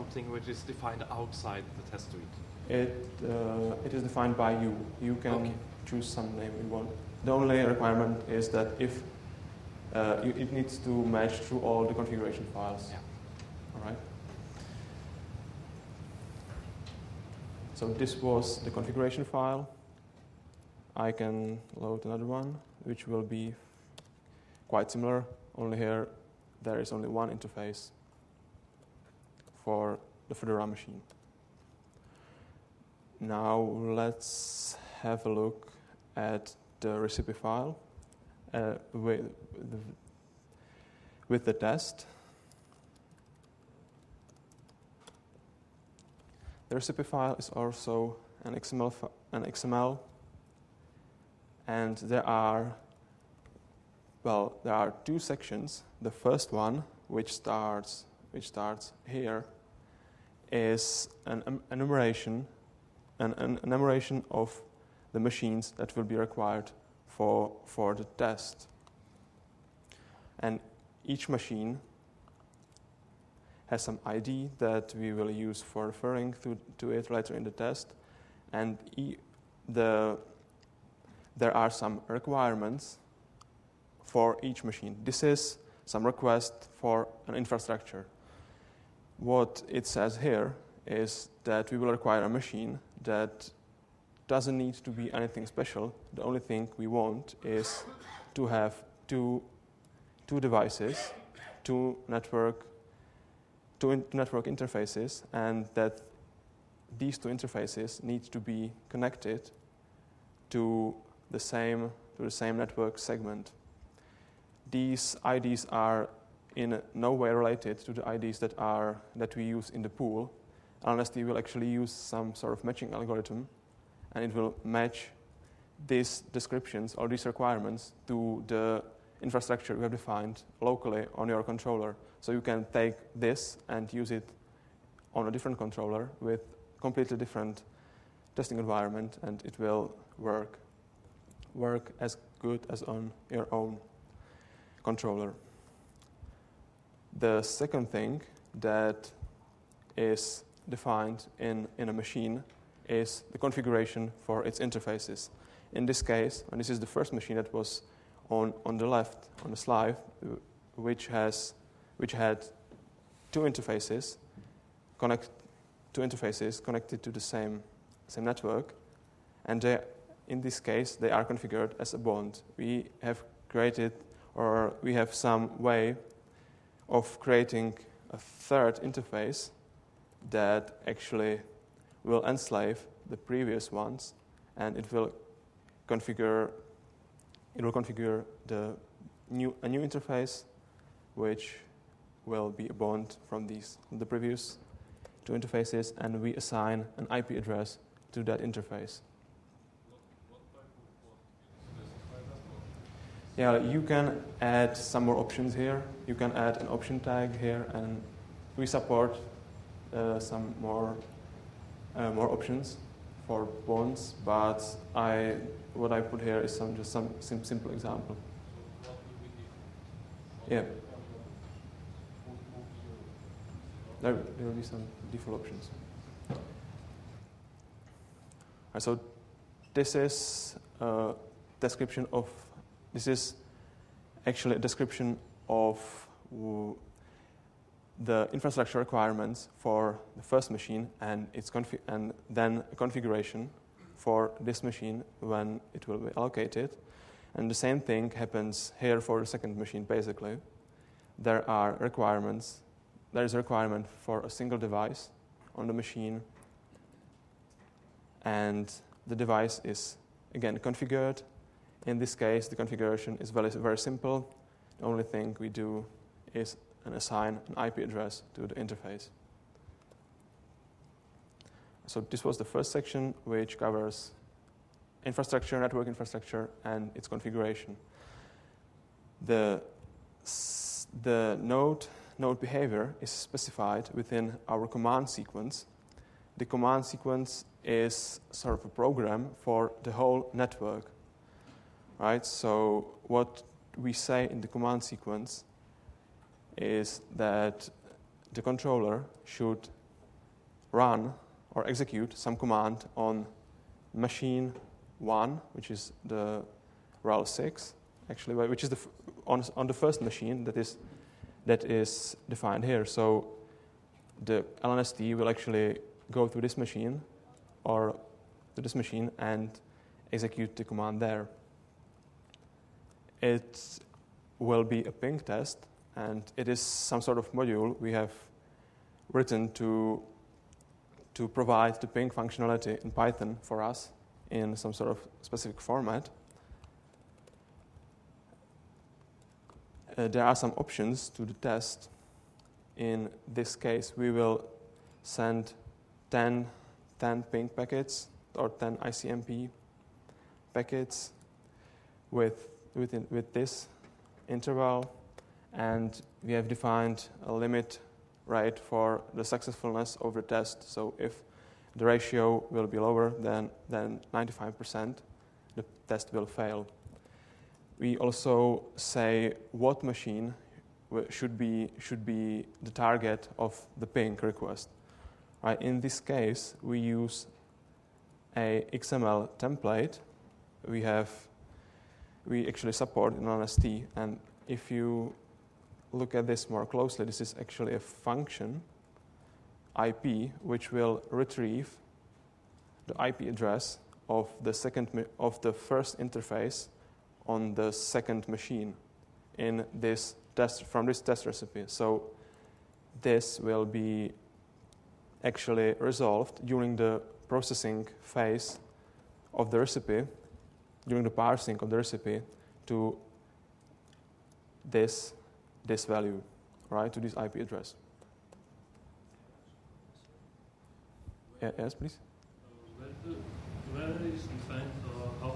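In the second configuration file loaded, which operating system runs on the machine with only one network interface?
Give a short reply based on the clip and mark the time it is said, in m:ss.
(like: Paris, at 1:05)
Fedora, at 0:30.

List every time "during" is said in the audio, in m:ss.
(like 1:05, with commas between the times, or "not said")
6:46, 6:50.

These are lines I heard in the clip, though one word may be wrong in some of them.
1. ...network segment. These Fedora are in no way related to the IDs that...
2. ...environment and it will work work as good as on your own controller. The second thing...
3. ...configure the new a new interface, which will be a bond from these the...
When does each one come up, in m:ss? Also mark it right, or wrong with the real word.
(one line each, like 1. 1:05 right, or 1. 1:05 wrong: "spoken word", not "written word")
1. 1:52 wrong: "IDs", not "Fedora"
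2. 2:18 right
3. 3:07 right.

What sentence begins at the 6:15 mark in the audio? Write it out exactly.
Right, in this case, we use a XML template.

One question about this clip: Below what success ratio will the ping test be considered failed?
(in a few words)
95%.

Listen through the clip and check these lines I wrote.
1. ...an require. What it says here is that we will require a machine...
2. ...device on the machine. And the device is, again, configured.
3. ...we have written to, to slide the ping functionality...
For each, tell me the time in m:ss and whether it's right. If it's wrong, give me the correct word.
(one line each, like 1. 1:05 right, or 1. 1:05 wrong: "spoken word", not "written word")
1. 1:27 wrong: "infrastructure", not "require"
2. 4:14 right
3. 5:27 wrong: "provide", not "slide".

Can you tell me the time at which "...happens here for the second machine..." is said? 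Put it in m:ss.
4:08.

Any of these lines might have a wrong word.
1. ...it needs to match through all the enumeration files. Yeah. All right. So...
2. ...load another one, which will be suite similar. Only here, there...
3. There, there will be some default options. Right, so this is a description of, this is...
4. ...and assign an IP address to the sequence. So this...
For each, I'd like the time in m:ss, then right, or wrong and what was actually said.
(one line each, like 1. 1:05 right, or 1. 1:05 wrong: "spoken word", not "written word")
1. 0:10 wrong: "configuration", not "enumeration"
2. 0:21 wrong: "quite", not "suite"
3. 3:44 right
4. 4:26 wrong: "interface", not "sequence".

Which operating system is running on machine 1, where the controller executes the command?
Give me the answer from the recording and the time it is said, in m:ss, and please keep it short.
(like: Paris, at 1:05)
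RHEL 6, at 5:07.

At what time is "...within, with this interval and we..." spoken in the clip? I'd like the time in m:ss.
5:52.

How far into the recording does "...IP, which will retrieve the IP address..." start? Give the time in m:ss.
6:29.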